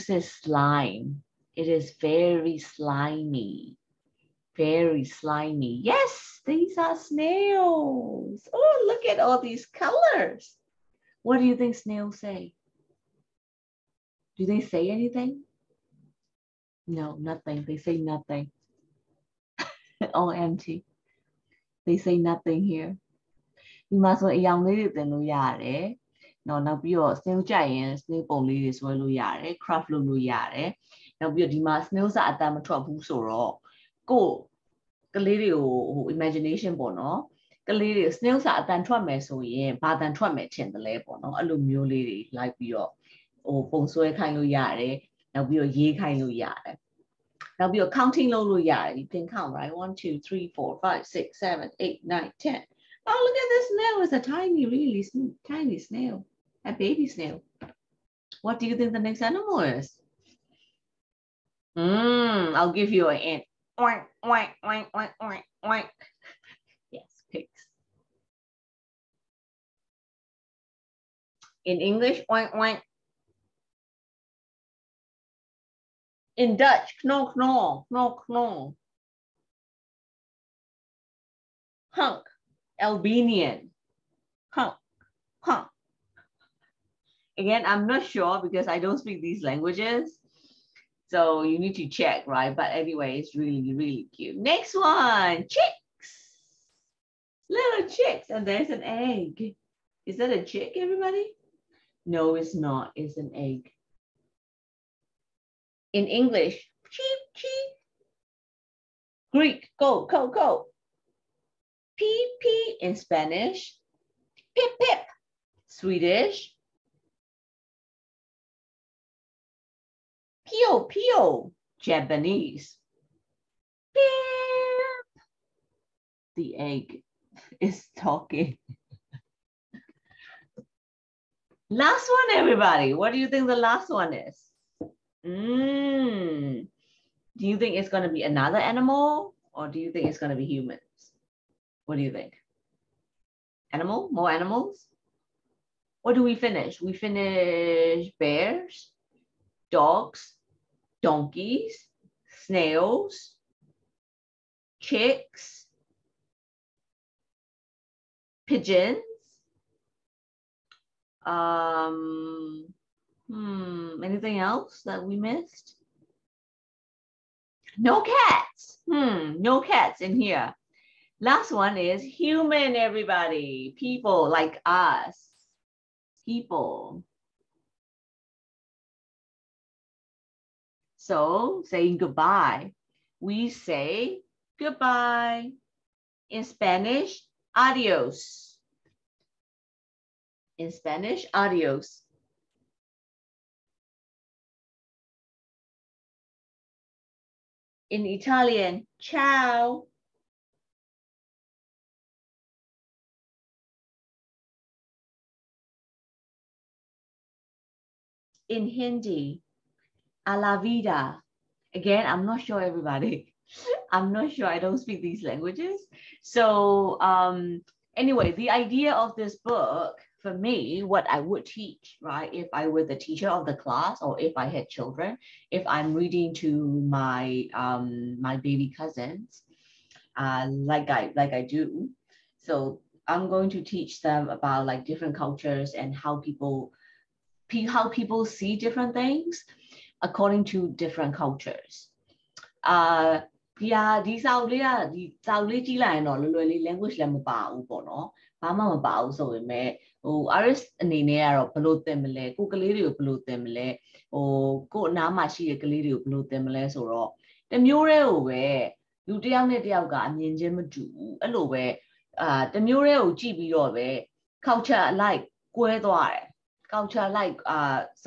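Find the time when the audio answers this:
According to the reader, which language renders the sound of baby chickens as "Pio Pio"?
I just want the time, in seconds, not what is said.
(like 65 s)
121 s.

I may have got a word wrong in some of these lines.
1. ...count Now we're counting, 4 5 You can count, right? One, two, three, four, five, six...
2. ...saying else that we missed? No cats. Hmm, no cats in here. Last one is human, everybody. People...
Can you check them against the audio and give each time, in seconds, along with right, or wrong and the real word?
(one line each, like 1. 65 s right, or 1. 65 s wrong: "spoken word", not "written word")
1. 46 s right
2. 164 s wrong: "anything", not "saying".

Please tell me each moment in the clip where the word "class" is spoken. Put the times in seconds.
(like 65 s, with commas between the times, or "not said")
223 s.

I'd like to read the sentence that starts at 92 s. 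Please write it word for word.
But anyway, it's really, really cute.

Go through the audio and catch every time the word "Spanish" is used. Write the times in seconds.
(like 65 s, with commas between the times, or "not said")
112 s, 186 s, 190 s.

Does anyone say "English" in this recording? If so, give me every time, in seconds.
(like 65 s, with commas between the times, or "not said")
71 s, 106 s.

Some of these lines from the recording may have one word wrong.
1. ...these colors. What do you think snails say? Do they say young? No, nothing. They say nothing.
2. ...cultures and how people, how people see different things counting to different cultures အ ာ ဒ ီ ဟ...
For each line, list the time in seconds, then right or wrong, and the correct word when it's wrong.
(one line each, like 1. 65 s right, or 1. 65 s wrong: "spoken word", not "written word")
1. 9 s wrong: "anything", not "young"
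2. 235 s wrong: "according", not "counting".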